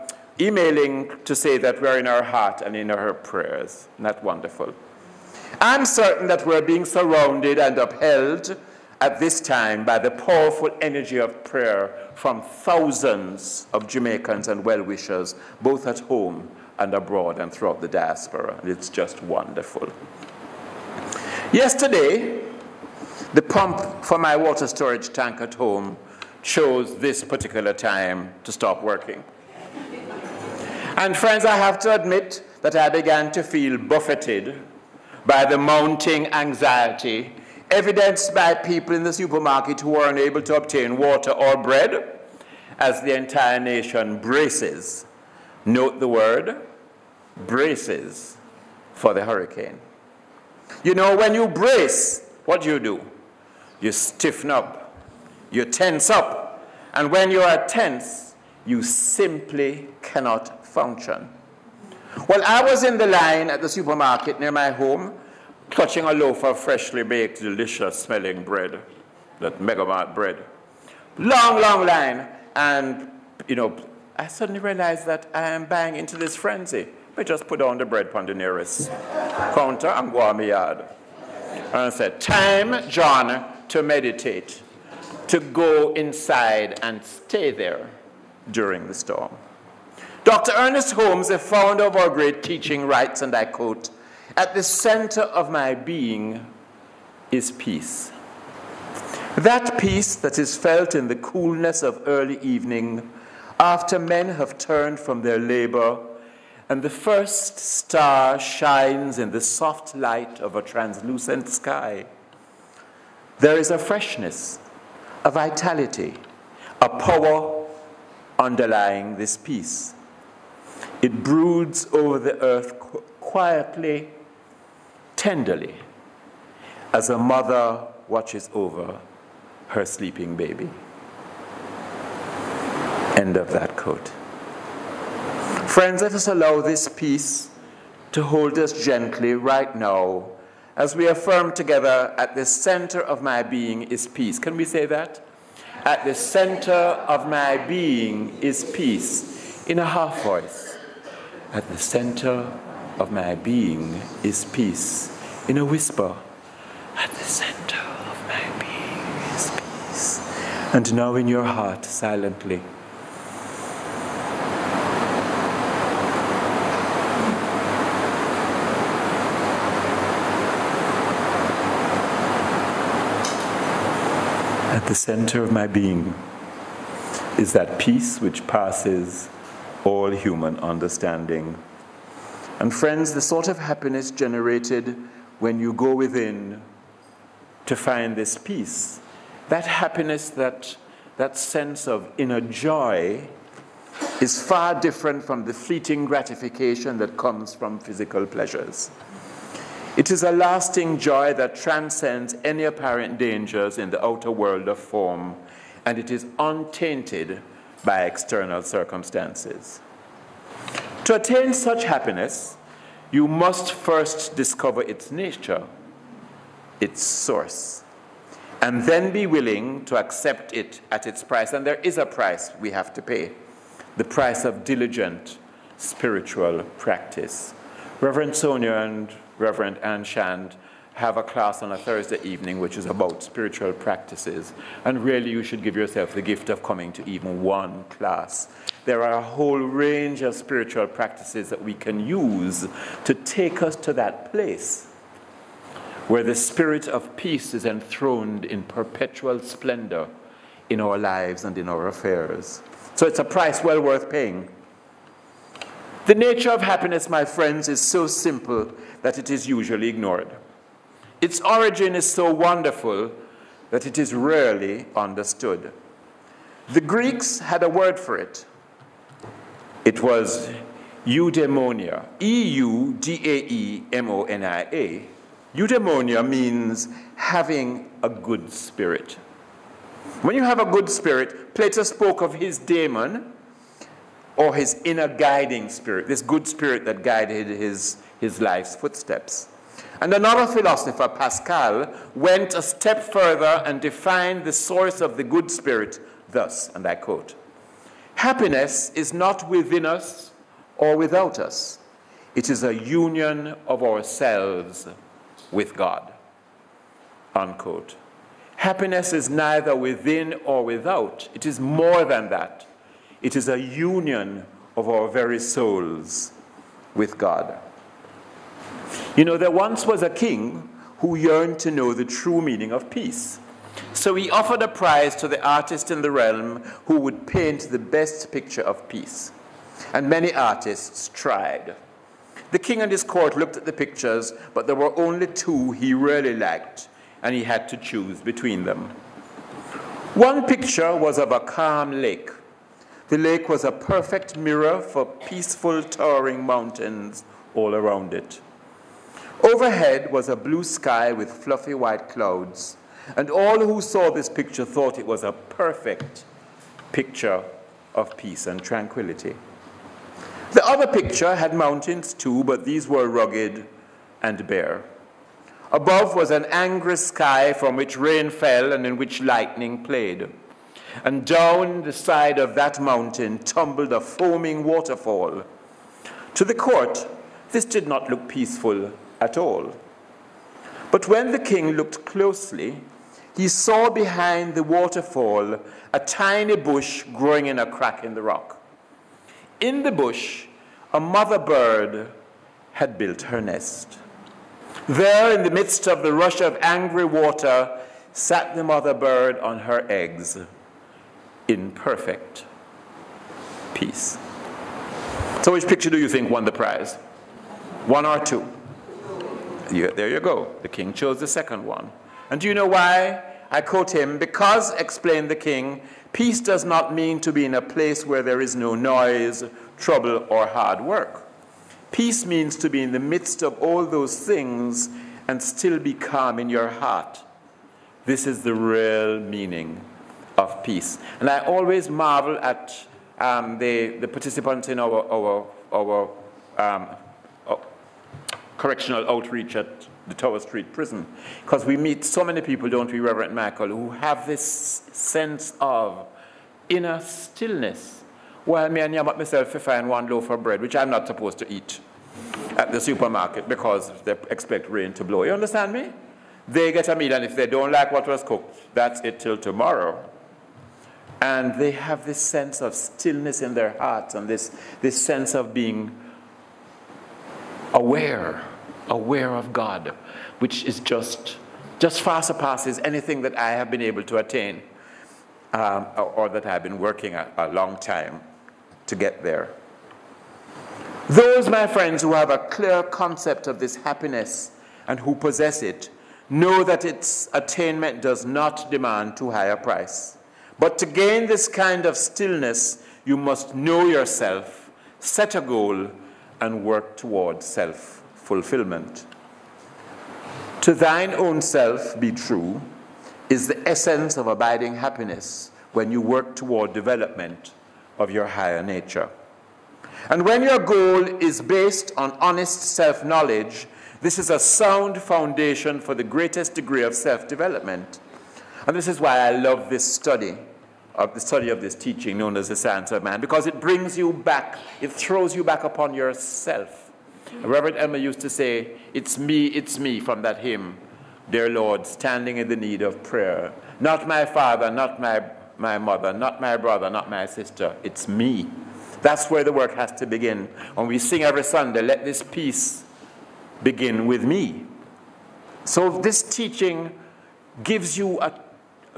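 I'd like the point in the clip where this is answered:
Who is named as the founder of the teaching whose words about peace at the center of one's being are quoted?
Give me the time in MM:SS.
01:30.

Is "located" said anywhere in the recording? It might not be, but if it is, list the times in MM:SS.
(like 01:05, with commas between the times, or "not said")
not said.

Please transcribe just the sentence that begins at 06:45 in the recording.
So, which picture do you think won the prize?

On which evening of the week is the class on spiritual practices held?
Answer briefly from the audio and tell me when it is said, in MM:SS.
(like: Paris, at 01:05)
Thursday, at 03:51.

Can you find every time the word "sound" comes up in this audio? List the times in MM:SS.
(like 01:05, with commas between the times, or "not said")
08:34.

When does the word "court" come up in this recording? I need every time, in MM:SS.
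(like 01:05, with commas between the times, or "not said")
05:33, 06:16.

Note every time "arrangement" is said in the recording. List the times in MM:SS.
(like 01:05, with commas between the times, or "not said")
not said.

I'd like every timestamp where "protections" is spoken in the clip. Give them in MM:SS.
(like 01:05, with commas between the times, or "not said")
not said.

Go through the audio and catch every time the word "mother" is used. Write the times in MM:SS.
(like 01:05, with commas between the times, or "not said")
02:07, 06:30, 06:38, 08:55.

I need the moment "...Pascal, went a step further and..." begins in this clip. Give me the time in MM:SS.
04:51.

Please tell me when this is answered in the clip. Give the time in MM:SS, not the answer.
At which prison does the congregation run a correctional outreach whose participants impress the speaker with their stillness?
07:20.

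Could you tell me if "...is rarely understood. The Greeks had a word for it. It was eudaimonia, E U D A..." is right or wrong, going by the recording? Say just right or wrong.
right.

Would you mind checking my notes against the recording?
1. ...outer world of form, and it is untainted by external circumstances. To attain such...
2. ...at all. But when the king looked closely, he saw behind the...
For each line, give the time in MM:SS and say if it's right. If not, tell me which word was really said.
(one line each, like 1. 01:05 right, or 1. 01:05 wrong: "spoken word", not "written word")
1. 03:24 right
2. 06:19 right.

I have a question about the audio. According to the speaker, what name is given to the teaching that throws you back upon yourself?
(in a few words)
Science of mind.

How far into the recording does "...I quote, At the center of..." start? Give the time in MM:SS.
01:33.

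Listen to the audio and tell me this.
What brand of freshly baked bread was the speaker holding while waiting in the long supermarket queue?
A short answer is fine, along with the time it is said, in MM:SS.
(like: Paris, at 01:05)
Megamart, at 01:09.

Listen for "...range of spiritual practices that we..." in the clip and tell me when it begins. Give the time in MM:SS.
03:59.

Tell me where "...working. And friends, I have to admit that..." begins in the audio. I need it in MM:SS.
00:28.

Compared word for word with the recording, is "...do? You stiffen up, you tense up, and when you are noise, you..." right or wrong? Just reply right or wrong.
wrong.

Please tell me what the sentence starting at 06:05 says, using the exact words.
Above was an angry sky from which rain fell and in which lightning played.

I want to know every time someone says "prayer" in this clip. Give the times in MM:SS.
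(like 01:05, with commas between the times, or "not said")
00:03, 00:11, 08:53.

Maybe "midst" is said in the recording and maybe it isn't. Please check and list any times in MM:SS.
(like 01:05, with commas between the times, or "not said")
06:35, 07:02.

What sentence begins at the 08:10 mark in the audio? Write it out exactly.
But to gain this kind of stillness, you must know yourself, set a goal, and work towards self fulfillment.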